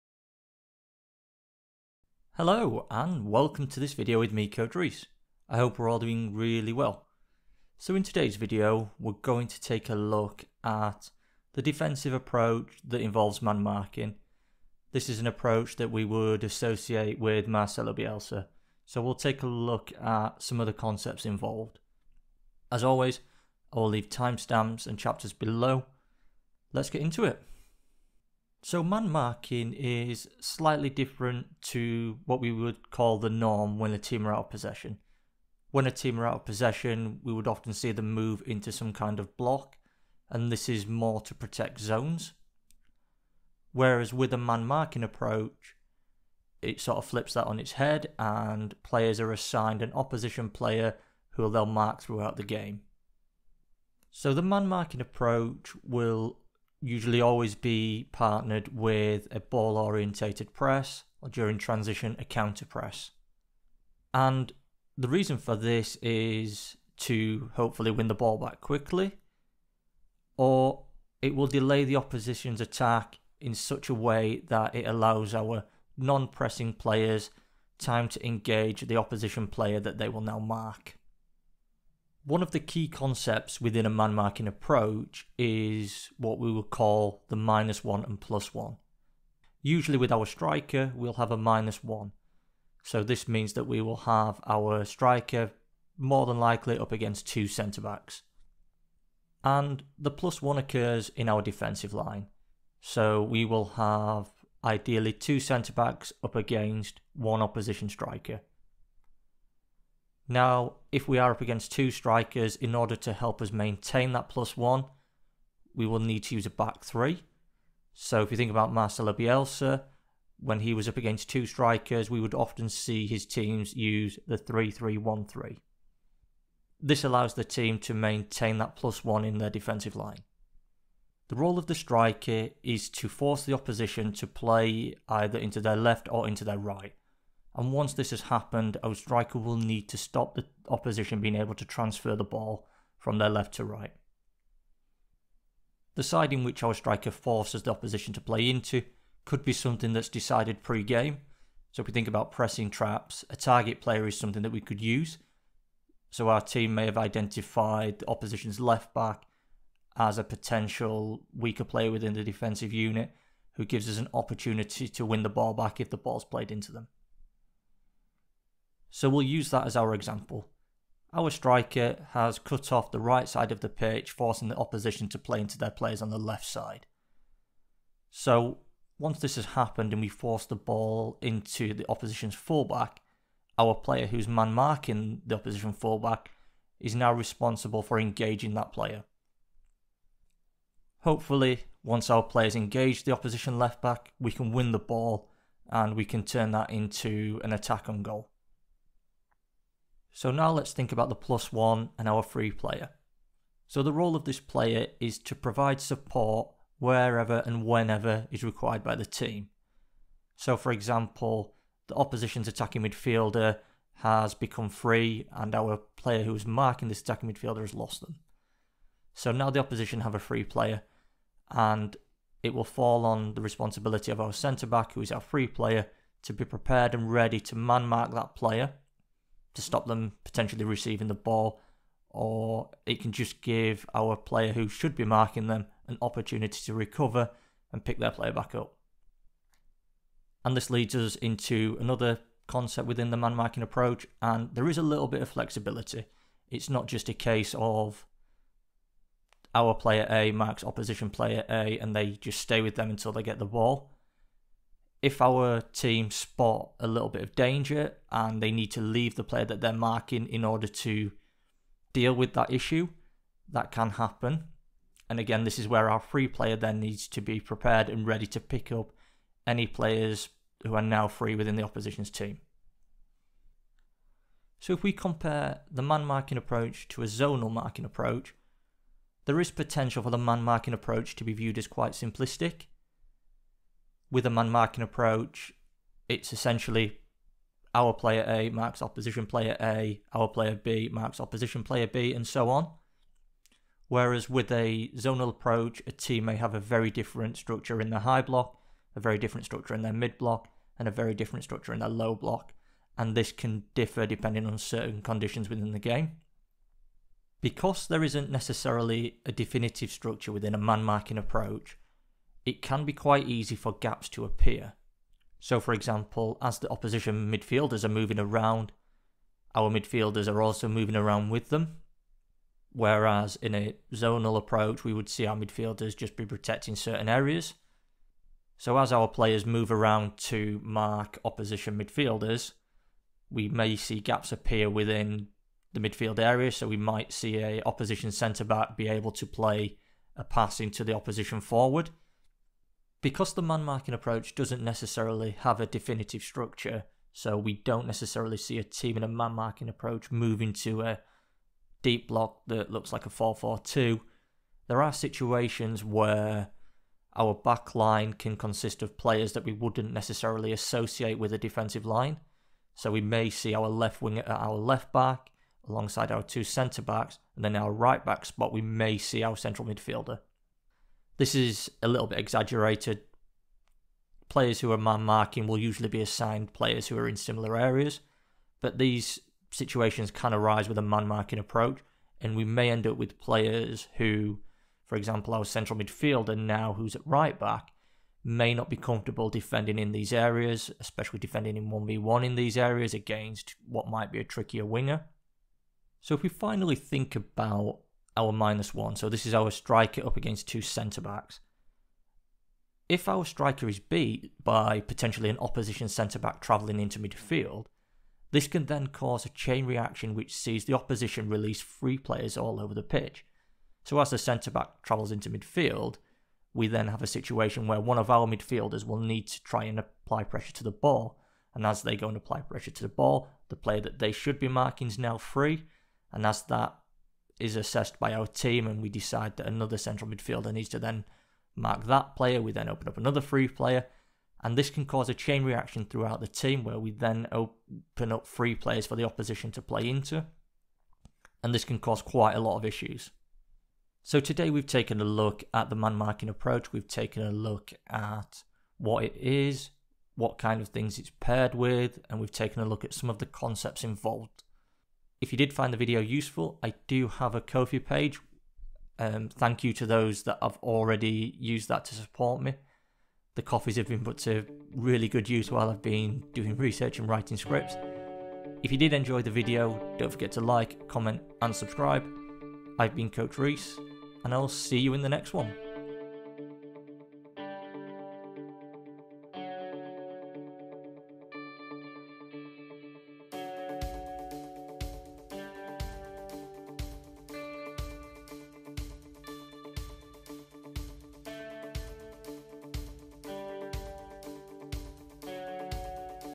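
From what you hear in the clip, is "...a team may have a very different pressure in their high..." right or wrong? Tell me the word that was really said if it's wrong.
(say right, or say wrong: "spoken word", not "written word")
wrong: "structure", not "pressure".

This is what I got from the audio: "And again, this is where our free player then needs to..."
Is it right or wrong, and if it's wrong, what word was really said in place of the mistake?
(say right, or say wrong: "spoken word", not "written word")
right.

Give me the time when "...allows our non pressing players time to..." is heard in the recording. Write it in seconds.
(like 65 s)
74 s.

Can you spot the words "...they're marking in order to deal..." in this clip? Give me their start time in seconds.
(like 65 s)
259 s.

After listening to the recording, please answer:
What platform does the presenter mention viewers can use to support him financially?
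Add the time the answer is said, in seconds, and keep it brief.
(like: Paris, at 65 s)
Ko-fi, at 457 s.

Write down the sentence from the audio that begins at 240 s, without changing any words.
And this leads us into another concept within the man marking approach, and there is a little bit of flexibility.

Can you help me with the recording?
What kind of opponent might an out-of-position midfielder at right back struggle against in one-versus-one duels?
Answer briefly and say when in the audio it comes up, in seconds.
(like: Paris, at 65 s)
Trickier winger, at 394 s.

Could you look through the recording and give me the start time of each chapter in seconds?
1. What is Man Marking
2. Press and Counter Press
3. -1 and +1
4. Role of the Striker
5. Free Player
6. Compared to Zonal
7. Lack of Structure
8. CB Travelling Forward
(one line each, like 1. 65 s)
1. 28 s
2. 54 s
3. 84 s
4. 132 s
5. 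204 s
6. 277 s
7. 314 s
8. 396 s.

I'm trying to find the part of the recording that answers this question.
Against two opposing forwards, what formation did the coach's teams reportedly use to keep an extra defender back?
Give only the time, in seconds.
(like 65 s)
124 s.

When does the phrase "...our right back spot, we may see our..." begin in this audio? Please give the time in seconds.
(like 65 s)
367 s.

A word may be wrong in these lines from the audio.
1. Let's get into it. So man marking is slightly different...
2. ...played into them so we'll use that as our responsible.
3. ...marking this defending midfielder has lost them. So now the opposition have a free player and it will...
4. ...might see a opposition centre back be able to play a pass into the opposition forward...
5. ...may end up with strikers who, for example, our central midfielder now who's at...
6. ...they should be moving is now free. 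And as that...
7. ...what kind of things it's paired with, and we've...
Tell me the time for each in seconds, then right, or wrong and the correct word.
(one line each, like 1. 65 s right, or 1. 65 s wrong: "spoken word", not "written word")
1. 26 s right
2. 166 s wrong: "example", not "responsible"
3. 216 s wrong: "attacking", not "defending"
4. 336 s right
5. 382 s wrong: "players", not "strikers"
6. 423 s wrong: "marking", not "moving"
7. 450 s right.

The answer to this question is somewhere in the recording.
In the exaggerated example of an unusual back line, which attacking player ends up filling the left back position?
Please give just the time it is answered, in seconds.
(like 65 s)
363 s.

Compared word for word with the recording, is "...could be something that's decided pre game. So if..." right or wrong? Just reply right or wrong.
right.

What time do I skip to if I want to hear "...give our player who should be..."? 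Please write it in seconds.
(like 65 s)
233 s.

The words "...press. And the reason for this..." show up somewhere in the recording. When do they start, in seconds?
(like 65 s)
62 s.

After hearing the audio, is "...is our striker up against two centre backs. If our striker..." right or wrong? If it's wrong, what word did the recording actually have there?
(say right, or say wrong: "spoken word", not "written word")
right.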